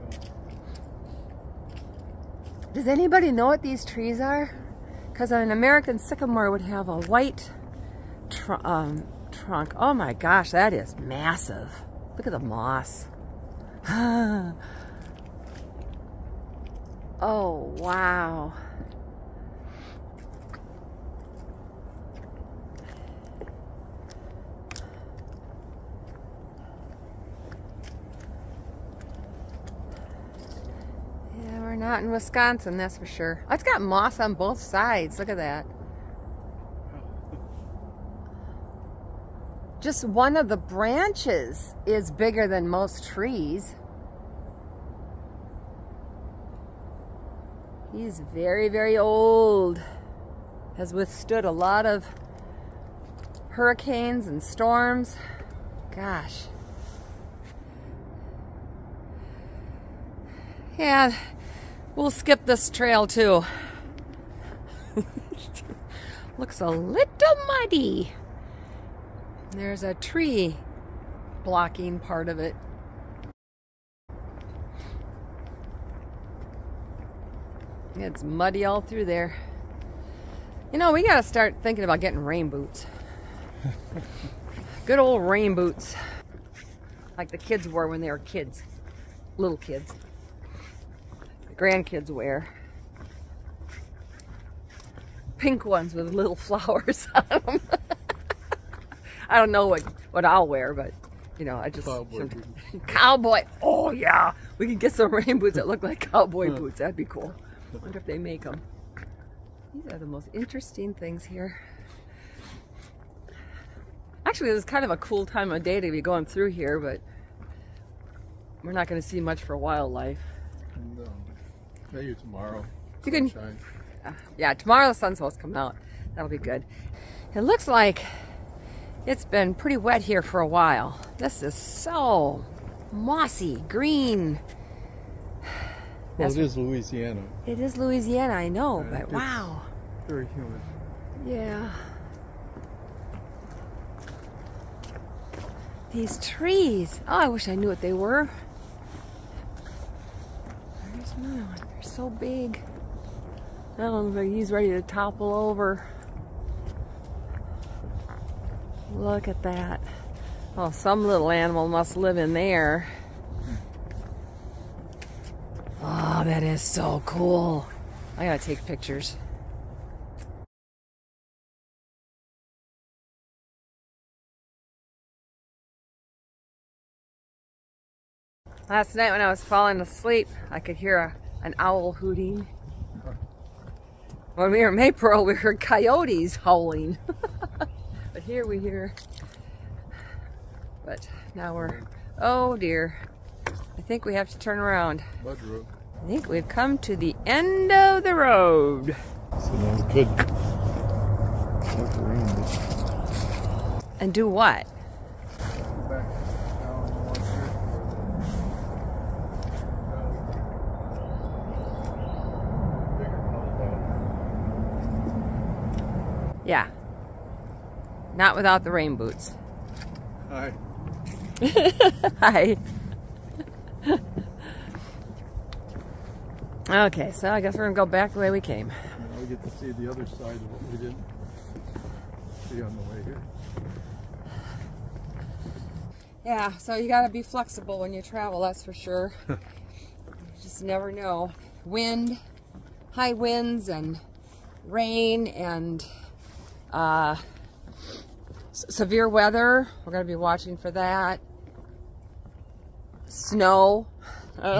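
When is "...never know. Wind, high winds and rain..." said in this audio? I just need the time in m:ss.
4:00.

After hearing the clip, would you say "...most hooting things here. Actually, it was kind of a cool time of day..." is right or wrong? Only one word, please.
wrong.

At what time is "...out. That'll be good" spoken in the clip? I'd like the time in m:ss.
2:05.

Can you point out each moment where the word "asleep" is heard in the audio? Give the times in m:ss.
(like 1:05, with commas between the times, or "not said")
2:59.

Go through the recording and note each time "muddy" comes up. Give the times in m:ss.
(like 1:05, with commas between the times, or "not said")
1:07, 1:18.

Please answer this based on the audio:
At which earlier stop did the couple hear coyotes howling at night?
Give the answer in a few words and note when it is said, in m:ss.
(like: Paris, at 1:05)
Maypearl, at 3:04.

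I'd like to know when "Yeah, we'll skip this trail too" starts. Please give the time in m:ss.
1:00.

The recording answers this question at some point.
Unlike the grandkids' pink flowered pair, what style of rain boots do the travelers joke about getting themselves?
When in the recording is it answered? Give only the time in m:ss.
1:46.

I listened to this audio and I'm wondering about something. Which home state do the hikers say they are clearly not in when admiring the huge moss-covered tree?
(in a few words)
Wisconsin.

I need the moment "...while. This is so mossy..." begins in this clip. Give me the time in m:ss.
2:10.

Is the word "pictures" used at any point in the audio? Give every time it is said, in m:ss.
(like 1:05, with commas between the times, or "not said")
2:48.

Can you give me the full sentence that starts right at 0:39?
Just one of the branches is bigger than most trees.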